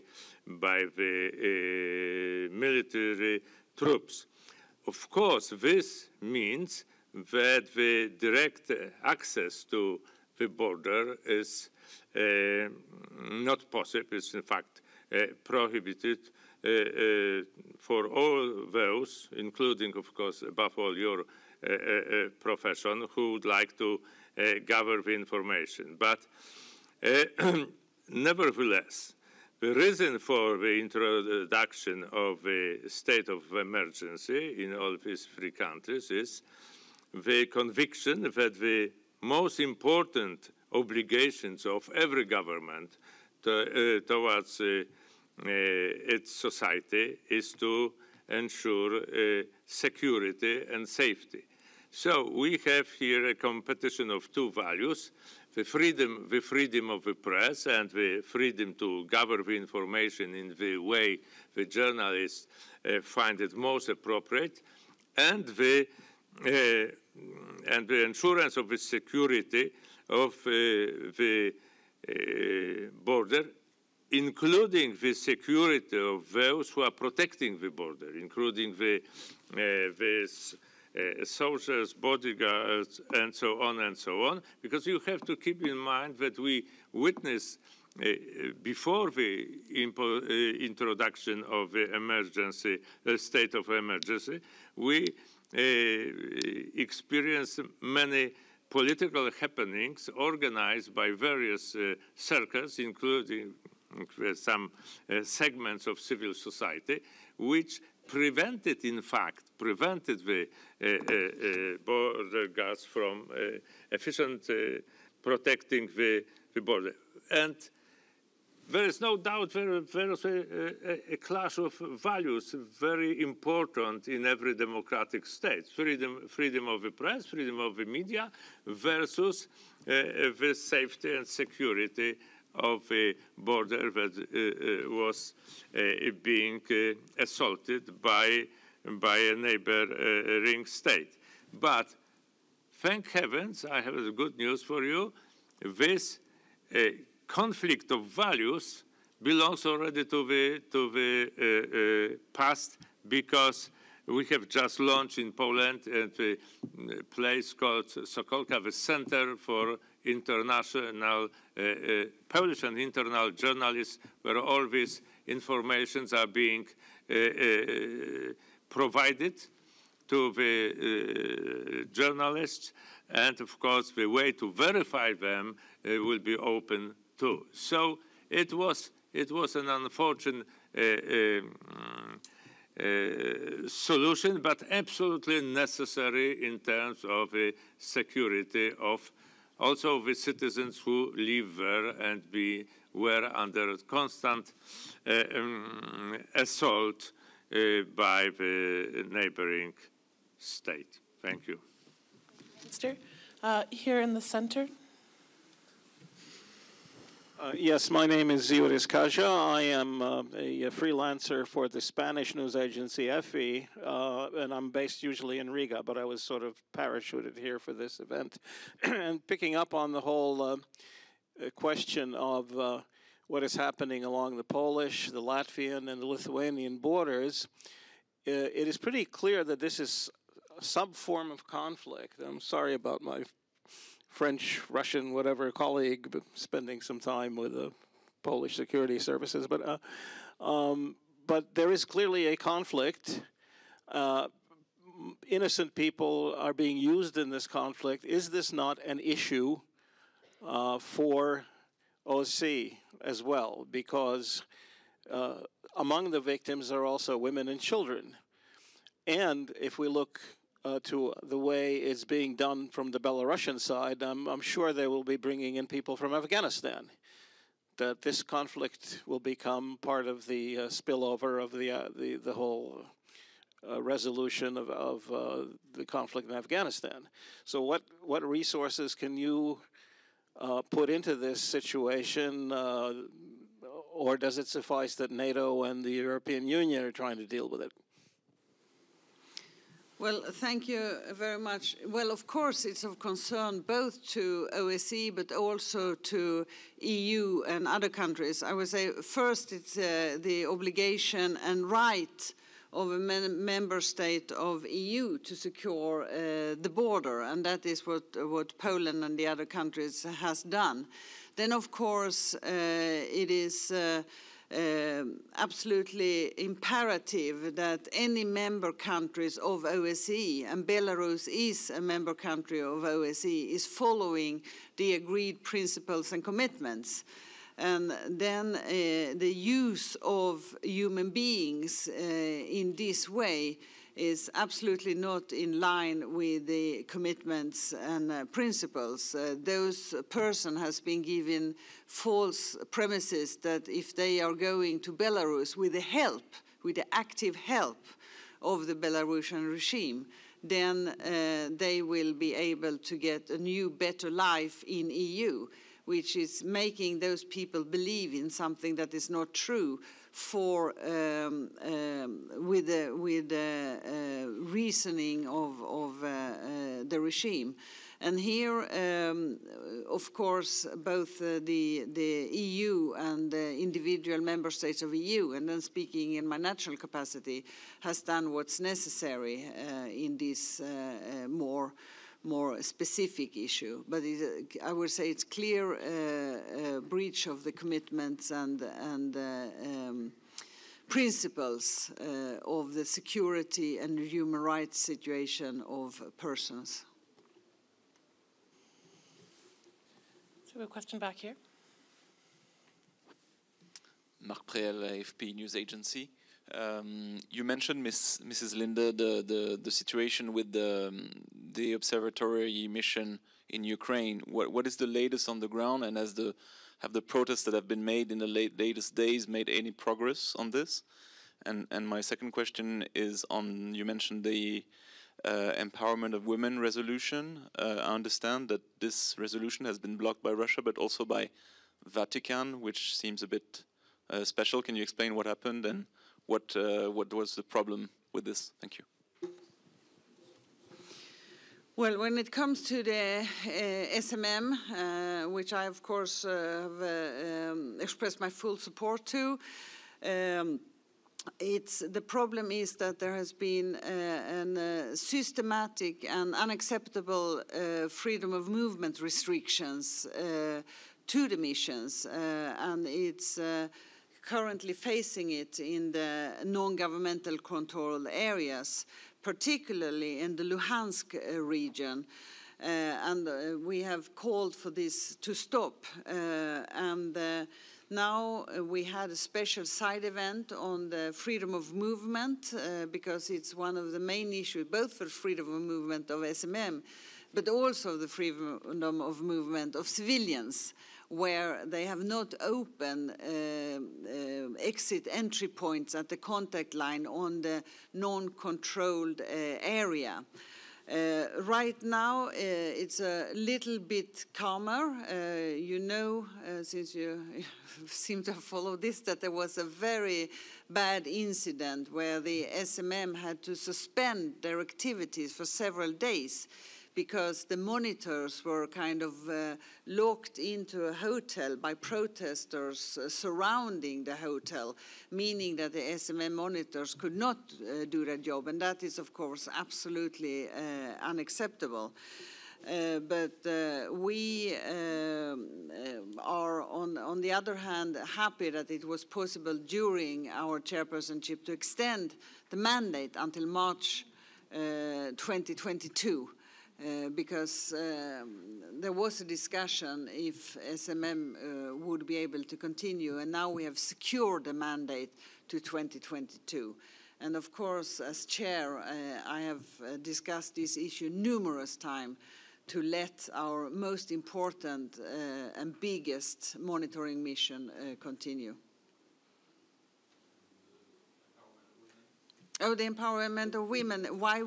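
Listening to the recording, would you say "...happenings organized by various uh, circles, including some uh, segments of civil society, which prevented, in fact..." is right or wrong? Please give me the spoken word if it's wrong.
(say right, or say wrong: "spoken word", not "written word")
right.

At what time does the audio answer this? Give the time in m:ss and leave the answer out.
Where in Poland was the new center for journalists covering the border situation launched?
2:37.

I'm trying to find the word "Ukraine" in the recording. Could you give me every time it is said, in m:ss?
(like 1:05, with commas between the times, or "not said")
6:53.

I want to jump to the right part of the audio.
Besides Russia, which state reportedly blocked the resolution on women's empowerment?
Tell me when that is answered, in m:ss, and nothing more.
7:11.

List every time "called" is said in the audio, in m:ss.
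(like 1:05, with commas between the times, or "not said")
2:37, 7:54.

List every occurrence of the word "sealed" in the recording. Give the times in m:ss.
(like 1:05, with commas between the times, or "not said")
not said.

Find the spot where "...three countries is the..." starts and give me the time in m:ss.
0:35.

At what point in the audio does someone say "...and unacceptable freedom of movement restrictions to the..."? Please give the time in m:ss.
7:36.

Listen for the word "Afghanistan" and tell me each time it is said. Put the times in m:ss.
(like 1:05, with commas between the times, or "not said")
4:26, 4:36.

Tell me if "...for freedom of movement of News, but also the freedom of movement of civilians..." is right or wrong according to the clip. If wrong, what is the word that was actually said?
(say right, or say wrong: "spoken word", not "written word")
wrong: "SMM", not "News".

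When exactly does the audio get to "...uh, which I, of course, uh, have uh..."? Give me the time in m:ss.
7:24.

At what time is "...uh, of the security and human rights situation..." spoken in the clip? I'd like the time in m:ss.
6:31.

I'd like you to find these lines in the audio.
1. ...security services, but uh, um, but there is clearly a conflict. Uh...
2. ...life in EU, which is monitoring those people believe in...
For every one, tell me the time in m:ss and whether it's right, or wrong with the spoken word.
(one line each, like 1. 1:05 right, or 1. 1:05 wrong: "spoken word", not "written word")
1. 3:58 right
2. 5:54 wrong: "making", not "monitoring".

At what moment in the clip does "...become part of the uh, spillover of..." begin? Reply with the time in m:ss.
4:29.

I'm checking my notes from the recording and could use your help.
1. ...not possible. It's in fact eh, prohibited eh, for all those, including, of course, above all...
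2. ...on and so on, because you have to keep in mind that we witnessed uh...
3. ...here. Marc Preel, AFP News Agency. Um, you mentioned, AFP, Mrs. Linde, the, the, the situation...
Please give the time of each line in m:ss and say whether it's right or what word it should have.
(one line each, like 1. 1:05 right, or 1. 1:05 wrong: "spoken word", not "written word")
1. 0:13 right
2. 1:23 right
3. 6:41 wrong: "Miss", not "AFP".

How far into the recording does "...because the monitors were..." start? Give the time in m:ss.
8:36.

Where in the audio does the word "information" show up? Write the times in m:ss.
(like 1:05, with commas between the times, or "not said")
0:25, 0:59, 2:45.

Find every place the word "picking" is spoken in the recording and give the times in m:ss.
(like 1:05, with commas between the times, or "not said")
3:39.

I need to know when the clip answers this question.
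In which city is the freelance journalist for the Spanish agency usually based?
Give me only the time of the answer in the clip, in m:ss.
3:35.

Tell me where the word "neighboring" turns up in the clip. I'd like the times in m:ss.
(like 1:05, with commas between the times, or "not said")
2:19, 3:19.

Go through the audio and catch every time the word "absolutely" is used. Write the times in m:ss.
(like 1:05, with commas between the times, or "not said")
3:04, 5:15, 5:34, 8:49.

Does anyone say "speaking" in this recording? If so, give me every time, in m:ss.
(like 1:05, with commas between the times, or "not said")
6:15.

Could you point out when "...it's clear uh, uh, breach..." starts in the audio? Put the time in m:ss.
6:25.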